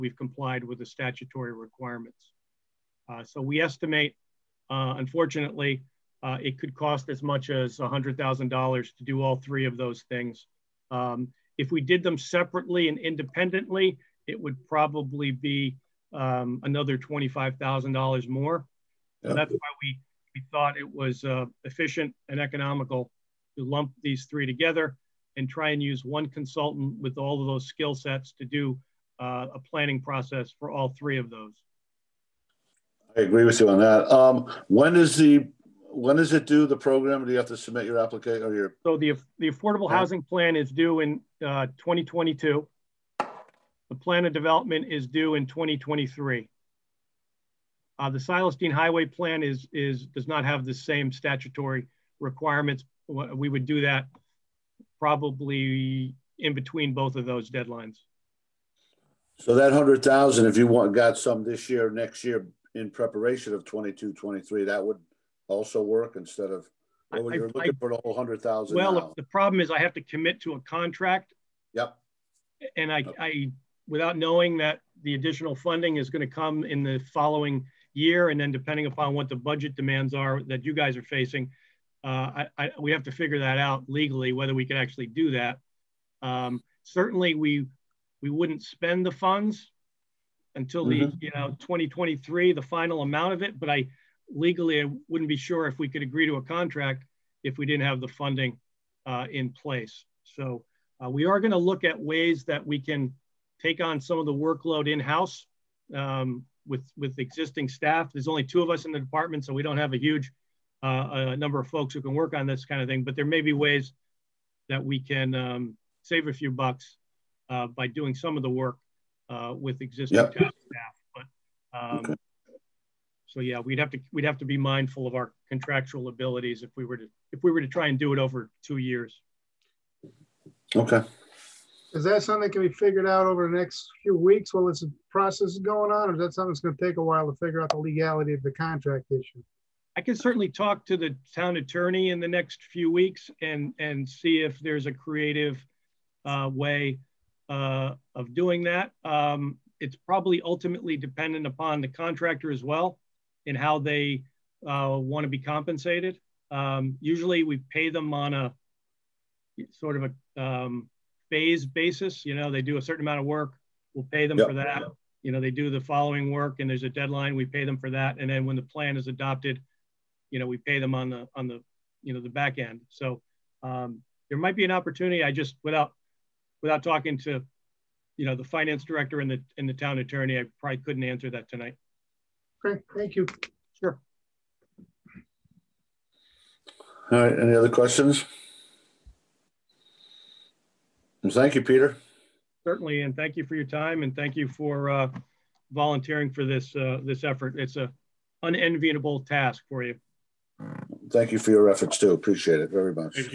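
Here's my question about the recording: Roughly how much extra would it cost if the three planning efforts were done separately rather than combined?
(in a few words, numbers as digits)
$25,000.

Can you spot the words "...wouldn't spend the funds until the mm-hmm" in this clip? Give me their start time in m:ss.
1:28.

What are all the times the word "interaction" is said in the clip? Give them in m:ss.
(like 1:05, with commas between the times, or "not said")
not said.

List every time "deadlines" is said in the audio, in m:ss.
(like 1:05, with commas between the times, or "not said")
0:57, 2:46.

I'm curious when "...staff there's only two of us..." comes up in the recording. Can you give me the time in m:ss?
1:47.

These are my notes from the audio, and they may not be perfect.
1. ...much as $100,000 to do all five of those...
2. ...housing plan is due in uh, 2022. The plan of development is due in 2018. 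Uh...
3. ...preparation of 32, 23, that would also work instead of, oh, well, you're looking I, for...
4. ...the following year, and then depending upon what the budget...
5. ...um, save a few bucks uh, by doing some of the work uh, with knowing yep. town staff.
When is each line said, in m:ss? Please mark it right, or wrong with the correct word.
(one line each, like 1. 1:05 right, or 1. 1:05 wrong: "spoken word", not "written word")
1. 0:07 wrong: "three", not "five"
2. 0:39 wrong: "2023", not "2018"
3. 1:02 wrong: "22", not "32"
4. 1:16 right
5. 1:55 wrong: "existing", not "knowing".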